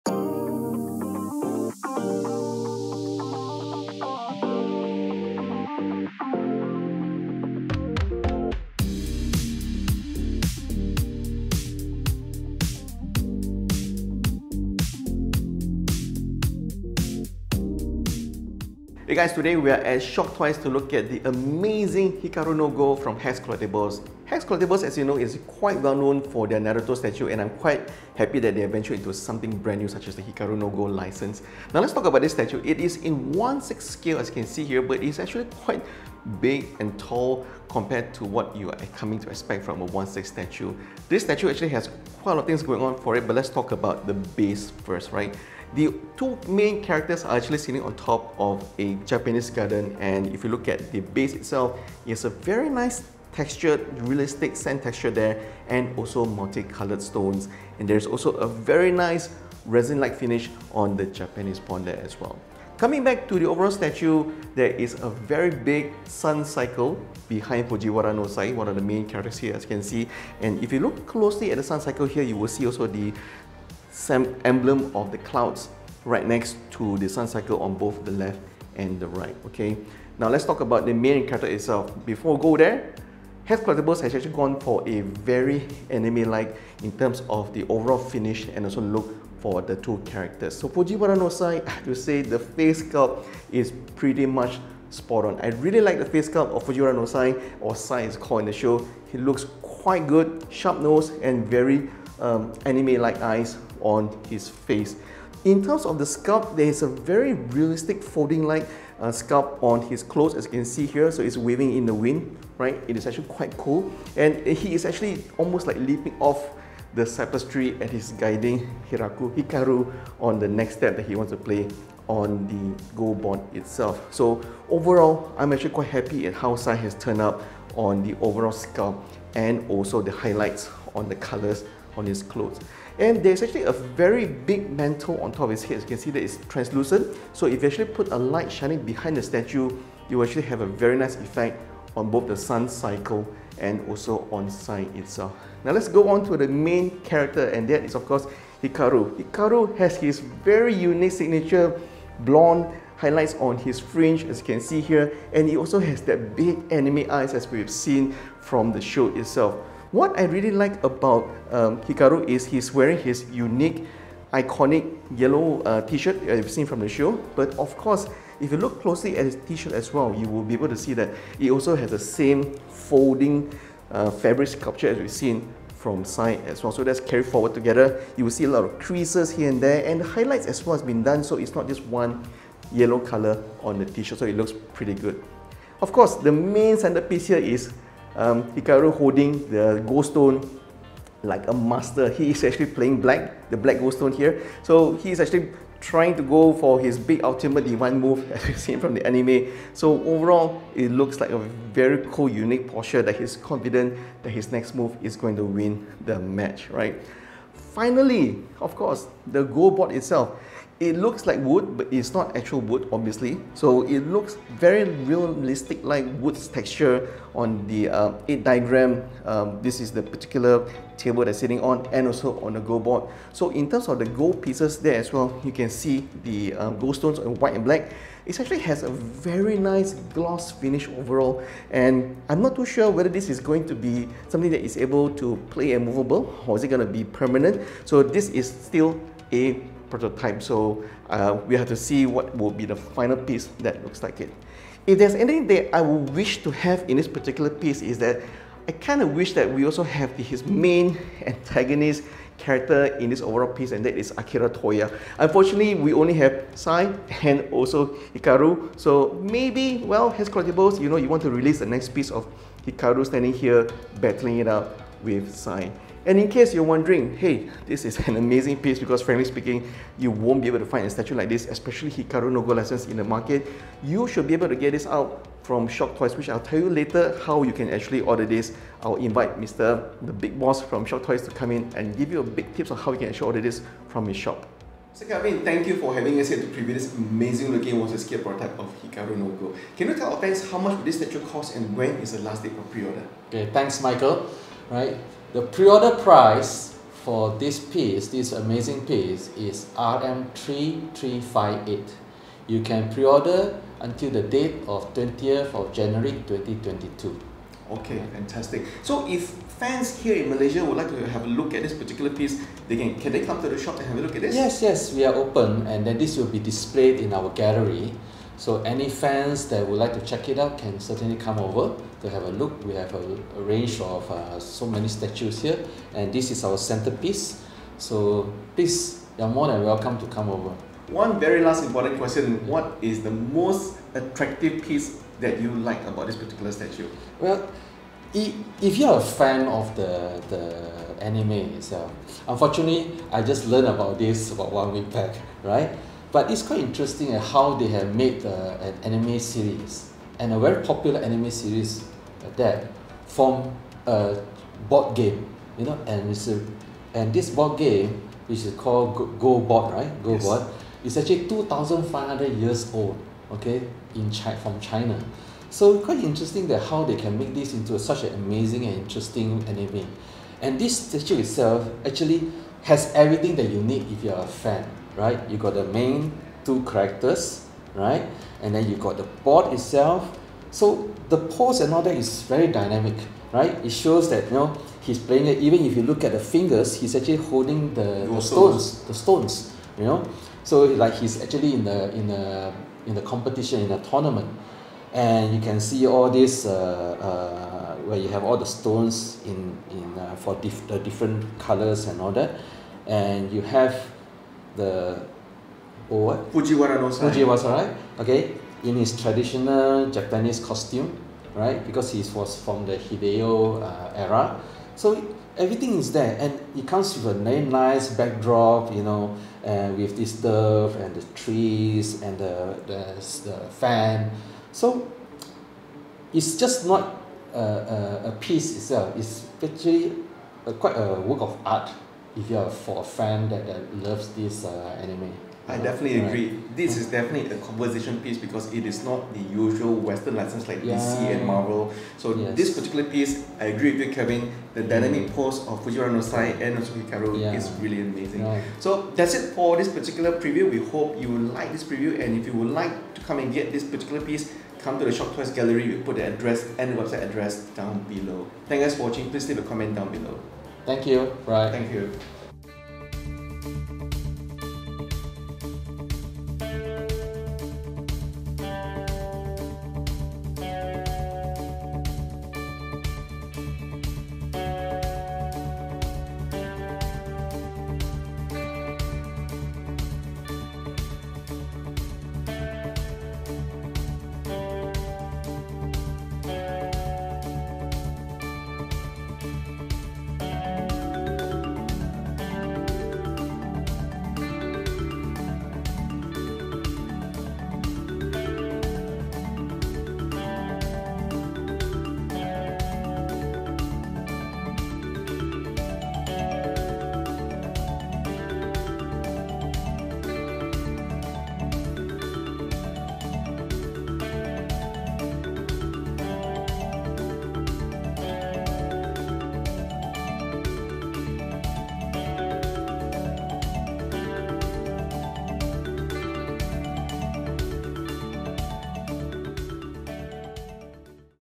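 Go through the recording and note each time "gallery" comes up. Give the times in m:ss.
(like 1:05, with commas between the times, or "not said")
5:17, 7:35.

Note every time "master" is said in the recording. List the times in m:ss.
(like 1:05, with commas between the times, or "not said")
3:11.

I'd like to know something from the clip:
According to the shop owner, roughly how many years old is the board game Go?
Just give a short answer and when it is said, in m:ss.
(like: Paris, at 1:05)
2,500 years, at 6:01.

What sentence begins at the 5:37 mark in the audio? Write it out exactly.
Well, if you're a fan of the the anime itself, unfortunately, I just learned about this about one week back, right?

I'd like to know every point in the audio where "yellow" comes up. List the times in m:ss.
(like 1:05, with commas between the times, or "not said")
2:45, 3:02.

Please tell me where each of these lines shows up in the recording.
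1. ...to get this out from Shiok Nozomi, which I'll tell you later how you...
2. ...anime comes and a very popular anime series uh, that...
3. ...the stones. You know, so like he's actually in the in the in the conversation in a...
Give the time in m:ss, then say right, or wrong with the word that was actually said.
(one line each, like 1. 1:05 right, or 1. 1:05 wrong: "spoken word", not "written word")
1. 4:34 wrong: "Toys", not "Nozomi"
2. 5:48 wrong: "series", not "comes"
3. 6:28 wrong: "competition", not "conversation".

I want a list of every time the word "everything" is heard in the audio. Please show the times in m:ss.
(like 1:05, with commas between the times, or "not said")
6:12, 6:55.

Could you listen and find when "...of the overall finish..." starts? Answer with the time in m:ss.
1:27.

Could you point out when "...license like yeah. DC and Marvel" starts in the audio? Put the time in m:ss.
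7:20.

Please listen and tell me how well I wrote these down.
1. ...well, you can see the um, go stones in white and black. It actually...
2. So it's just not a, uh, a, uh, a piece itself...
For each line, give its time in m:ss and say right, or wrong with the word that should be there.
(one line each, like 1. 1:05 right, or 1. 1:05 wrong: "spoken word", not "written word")
1. 3:45 right
2. 7:04 right.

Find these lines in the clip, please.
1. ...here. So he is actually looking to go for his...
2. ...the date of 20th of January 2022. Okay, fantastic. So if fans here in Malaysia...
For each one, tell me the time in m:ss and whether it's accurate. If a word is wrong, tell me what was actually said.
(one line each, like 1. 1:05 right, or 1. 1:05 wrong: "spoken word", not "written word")
1. 3:14 wrong: "trying", not "looking"
2. 5:04 right.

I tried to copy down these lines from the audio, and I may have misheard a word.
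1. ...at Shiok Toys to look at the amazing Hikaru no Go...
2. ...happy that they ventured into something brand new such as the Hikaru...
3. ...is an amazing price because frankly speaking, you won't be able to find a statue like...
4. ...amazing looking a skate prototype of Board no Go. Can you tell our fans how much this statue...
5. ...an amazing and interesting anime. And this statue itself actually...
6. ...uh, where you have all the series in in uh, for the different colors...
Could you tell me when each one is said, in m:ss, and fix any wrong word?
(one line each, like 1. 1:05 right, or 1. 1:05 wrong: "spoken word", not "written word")
1. 0:19 right
2. 0:28 right
3. 4:27 wrong: "piece", not "price"
4. 4:46 wrong: "Hikaru", not "Board"
5. 6:08 right
6. 6:36 wrong: "stones", not "series".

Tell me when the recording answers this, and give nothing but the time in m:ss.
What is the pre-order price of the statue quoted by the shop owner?
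4:59.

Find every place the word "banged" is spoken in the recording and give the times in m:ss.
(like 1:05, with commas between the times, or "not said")
not said.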